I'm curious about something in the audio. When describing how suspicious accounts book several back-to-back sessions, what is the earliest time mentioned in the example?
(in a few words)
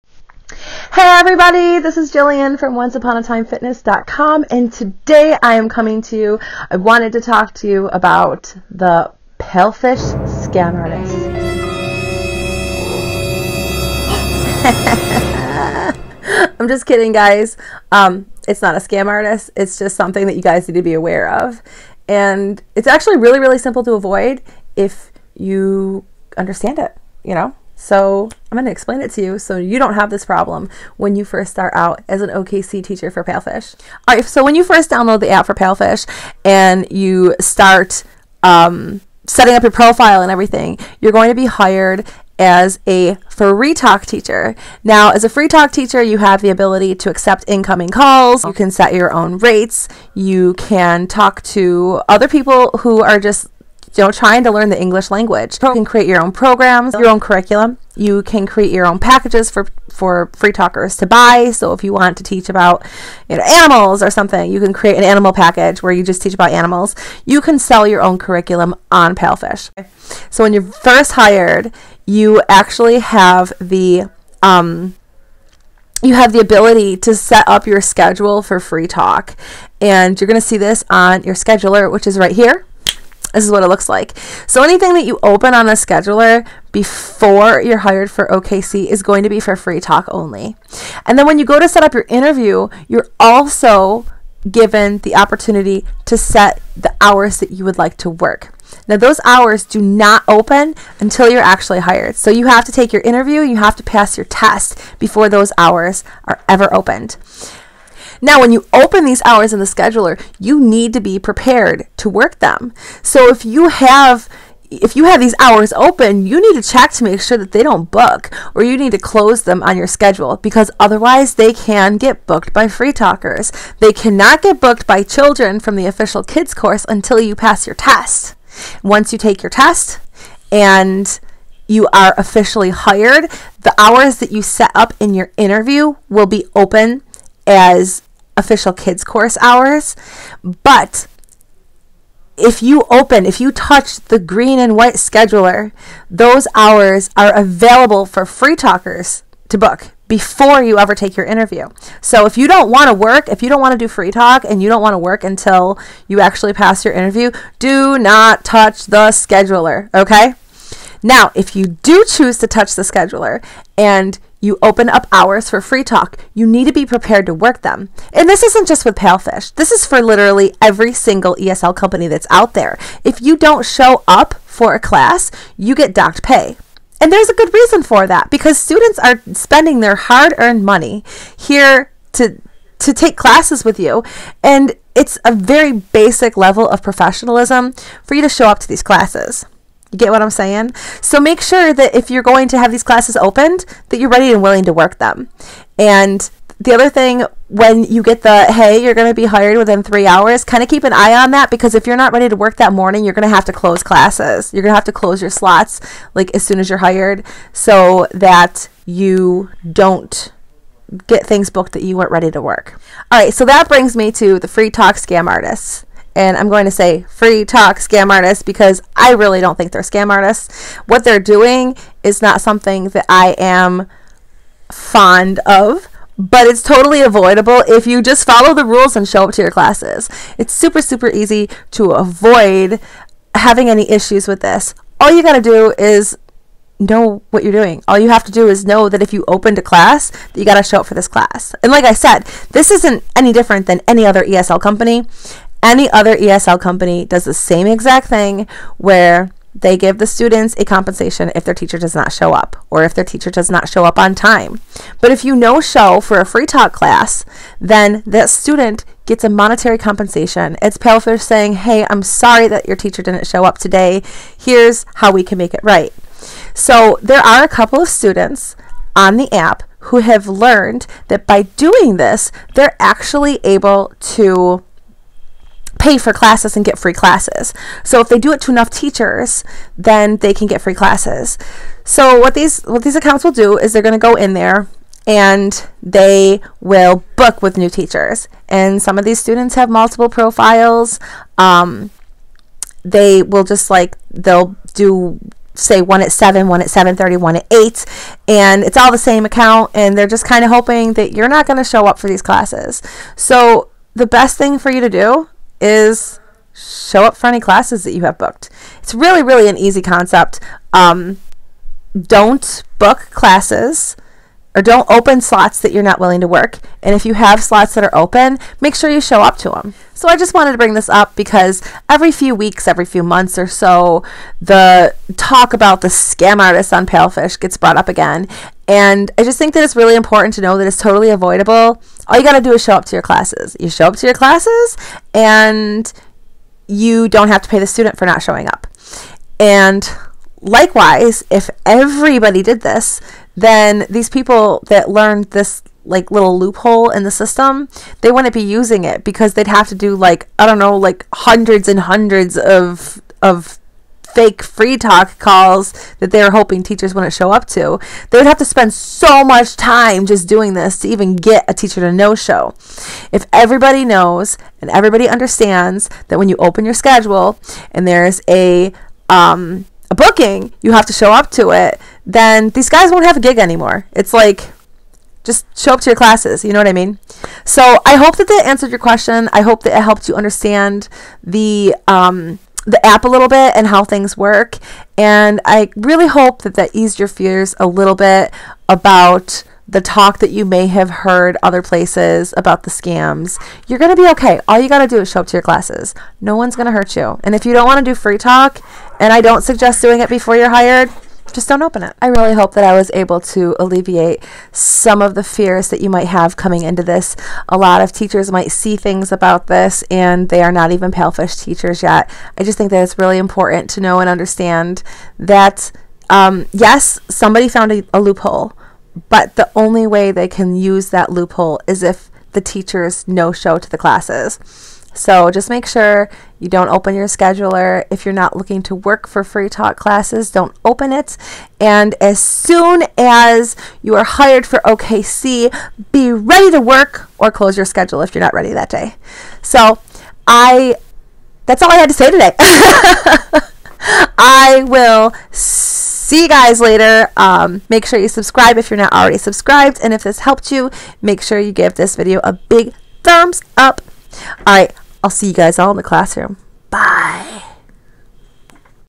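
7.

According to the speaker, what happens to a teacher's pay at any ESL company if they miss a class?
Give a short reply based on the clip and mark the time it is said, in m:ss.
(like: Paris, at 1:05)
docked pay, at 2:55.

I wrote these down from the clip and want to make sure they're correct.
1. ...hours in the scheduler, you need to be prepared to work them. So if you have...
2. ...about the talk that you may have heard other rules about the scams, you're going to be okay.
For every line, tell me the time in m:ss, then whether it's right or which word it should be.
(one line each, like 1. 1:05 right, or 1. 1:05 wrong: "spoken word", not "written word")
1. 1:49 right
2. 6:28 wrong: "places", not "rules".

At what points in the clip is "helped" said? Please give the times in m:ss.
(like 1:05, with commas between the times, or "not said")
6:19, 7:30.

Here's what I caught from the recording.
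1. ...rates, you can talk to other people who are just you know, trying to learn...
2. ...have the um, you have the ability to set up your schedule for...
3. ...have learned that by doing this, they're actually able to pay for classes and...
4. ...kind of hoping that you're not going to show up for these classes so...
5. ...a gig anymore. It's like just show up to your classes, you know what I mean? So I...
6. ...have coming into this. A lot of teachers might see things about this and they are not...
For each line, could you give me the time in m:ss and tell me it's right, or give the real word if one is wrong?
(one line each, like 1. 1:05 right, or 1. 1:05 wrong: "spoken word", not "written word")
1. 0:49 right
2. 1:12 right
3. 4:29 right
4. 5:00 right
5. 6:13 right
6. 6:46 right.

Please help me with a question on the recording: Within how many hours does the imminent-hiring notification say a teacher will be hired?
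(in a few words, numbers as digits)
3 hours.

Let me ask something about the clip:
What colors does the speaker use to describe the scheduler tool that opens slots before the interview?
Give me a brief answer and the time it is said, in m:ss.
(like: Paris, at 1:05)
green and white, at 2:24.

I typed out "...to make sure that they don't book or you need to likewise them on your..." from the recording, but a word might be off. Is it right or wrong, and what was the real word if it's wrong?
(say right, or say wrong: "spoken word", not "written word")
wrong: "close", not "likewise".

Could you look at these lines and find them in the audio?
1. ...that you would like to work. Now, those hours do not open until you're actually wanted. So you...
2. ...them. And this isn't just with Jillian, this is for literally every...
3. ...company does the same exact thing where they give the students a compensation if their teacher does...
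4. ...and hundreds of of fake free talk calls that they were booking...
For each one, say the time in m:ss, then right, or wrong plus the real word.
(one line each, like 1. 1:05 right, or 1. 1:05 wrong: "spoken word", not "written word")
1. 1:37 wrong: "hired", not "wanted"
2. 2:47 wrong: "Palfish", not "Jillian"
3. 4:06 right
4. 5:51 wrong: "hoping", not "booking".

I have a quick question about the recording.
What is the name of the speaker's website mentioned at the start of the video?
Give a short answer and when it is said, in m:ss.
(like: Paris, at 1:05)
onceuponatimefitness.com, at 0:02.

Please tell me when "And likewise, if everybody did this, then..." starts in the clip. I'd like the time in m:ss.
5:39.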